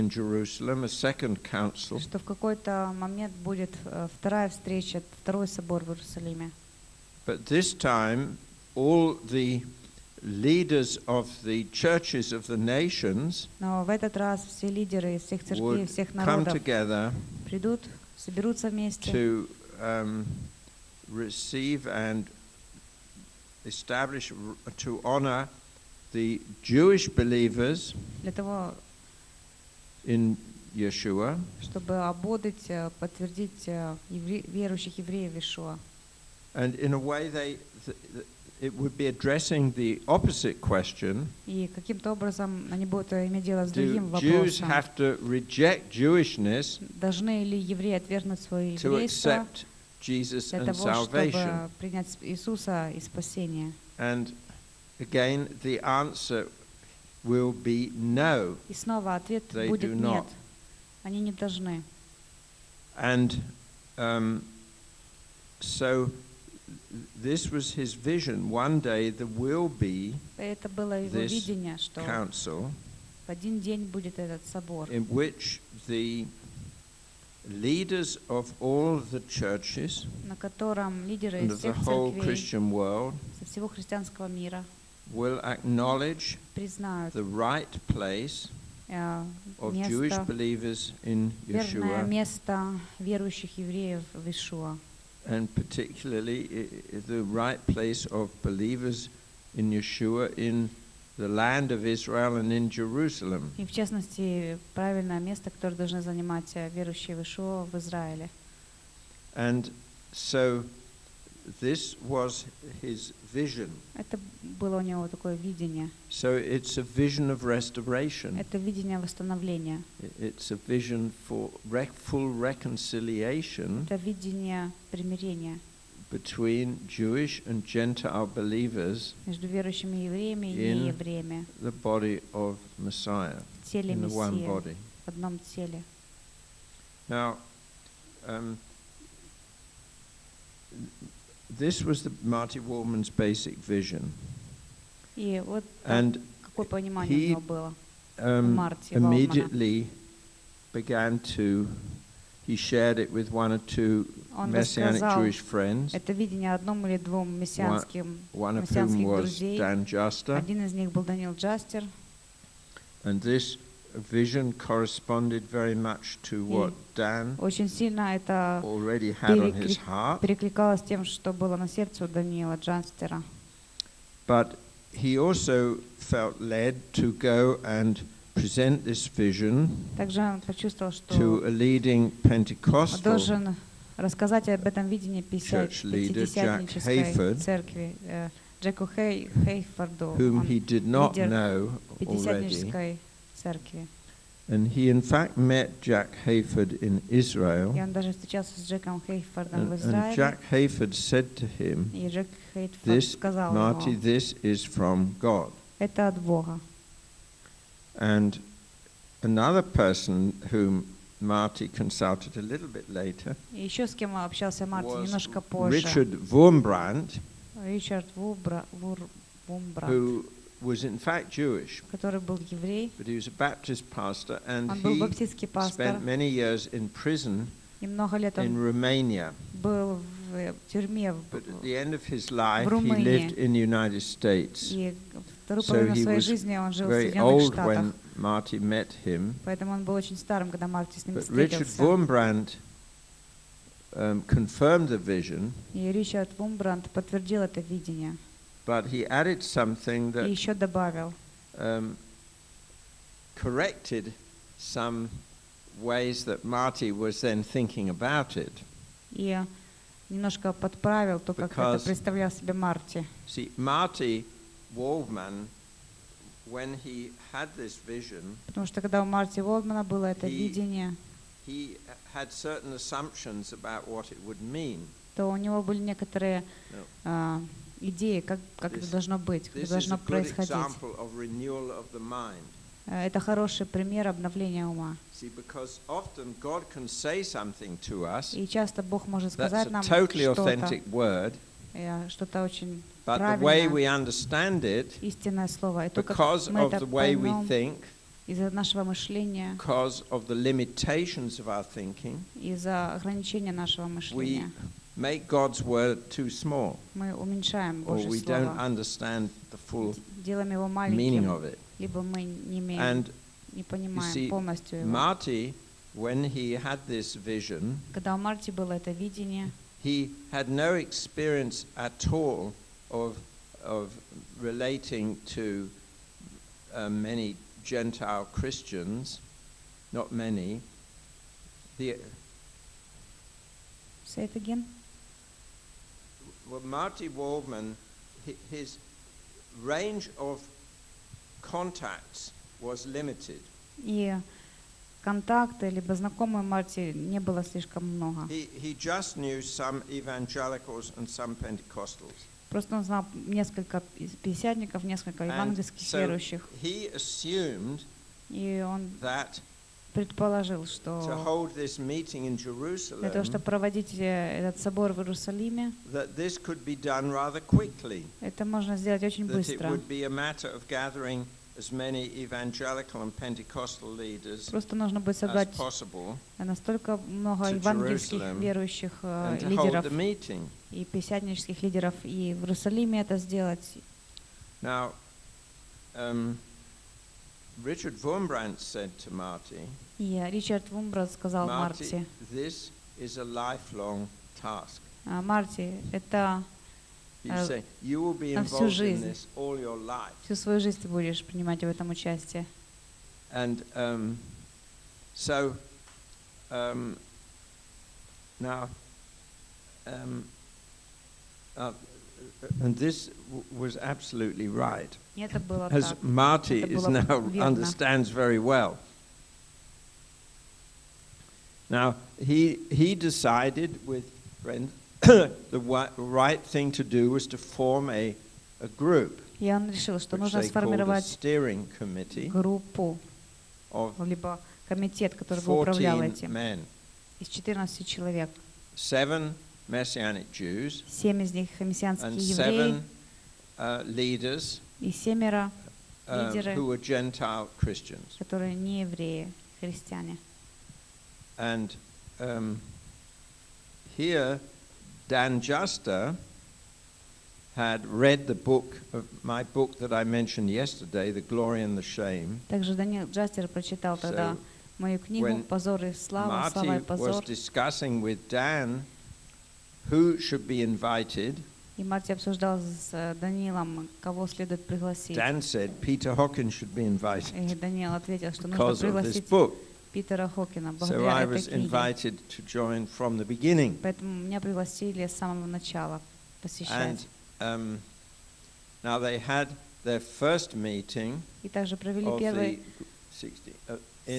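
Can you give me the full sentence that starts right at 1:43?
И в частности, правильное место, которое должны занимать верующие в в Израиле.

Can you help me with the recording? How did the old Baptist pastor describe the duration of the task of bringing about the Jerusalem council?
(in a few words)
lifelong task.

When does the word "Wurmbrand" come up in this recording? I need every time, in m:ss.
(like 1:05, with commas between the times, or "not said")
3:36, 4:01, 6:28.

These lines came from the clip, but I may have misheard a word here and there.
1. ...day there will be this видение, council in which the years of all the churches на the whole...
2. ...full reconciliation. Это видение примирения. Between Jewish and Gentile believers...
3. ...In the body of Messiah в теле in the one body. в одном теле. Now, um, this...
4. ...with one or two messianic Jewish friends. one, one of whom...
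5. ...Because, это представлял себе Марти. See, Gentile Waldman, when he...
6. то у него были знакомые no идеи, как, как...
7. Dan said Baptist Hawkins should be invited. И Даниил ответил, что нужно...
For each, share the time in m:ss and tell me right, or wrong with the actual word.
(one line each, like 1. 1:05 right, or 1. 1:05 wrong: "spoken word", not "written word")
1. 1:08 wrong: "leaders", not "years"
2. 2:02 right
3. 2:11 right
4. 2:33 right
5. 4:21 wrong: "Marty", not "Gentile"
6. 4:35 wrong: "некоторые", not "знакомые"
7. 7:55 wrong: "Peter", not "Baptist".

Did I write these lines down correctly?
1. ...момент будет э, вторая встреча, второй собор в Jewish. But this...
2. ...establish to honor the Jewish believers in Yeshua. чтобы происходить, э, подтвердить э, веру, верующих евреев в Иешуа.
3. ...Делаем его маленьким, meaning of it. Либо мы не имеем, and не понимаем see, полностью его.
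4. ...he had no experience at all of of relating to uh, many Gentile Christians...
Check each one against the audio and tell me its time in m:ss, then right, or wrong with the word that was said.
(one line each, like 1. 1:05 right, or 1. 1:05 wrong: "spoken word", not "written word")
1. 0:02 wrong: "Иерусалиме", not "Jewish"
2. 0:23 wrong: "ободрить", not "происходить"
3. 5:10 right
4. 5:19 right.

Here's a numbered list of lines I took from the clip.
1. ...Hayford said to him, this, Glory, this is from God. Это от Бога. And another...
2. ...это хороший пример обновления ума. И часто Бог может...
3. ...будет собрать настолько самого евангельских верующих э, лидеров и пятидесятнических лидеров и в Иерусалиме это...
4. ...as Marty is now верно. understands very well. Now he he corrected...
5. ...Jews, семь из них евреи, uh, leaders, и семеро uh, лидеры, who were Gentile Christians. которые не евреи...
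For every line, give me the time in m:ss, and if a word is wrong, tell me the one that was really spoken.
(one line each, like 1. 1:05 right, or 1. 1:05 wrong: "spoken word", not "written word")
1. 3:20 wrong: "Marty", not "Glory"
2. 4:43 right
3. 6:15 wrong: "много", not "самого"
4. 6:55 wrong: "decided", not "corrected"
5. 7:20 right.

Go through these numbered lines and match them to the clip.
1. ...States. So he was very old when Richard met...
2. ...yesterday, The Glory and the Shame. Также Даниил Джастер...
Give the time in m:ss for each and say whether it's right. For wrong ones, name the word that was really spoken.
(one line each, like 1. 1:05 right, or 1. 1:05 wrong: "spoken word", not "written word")
1. 3:54 wrong: "Marty", not "Richard"
2. 7:40 right.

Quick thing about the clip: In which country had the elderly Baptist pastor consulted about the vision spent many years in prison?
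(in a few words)
Romania.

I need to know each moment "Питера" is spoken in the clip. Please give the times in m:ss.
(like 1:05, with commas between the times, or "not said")
7:59.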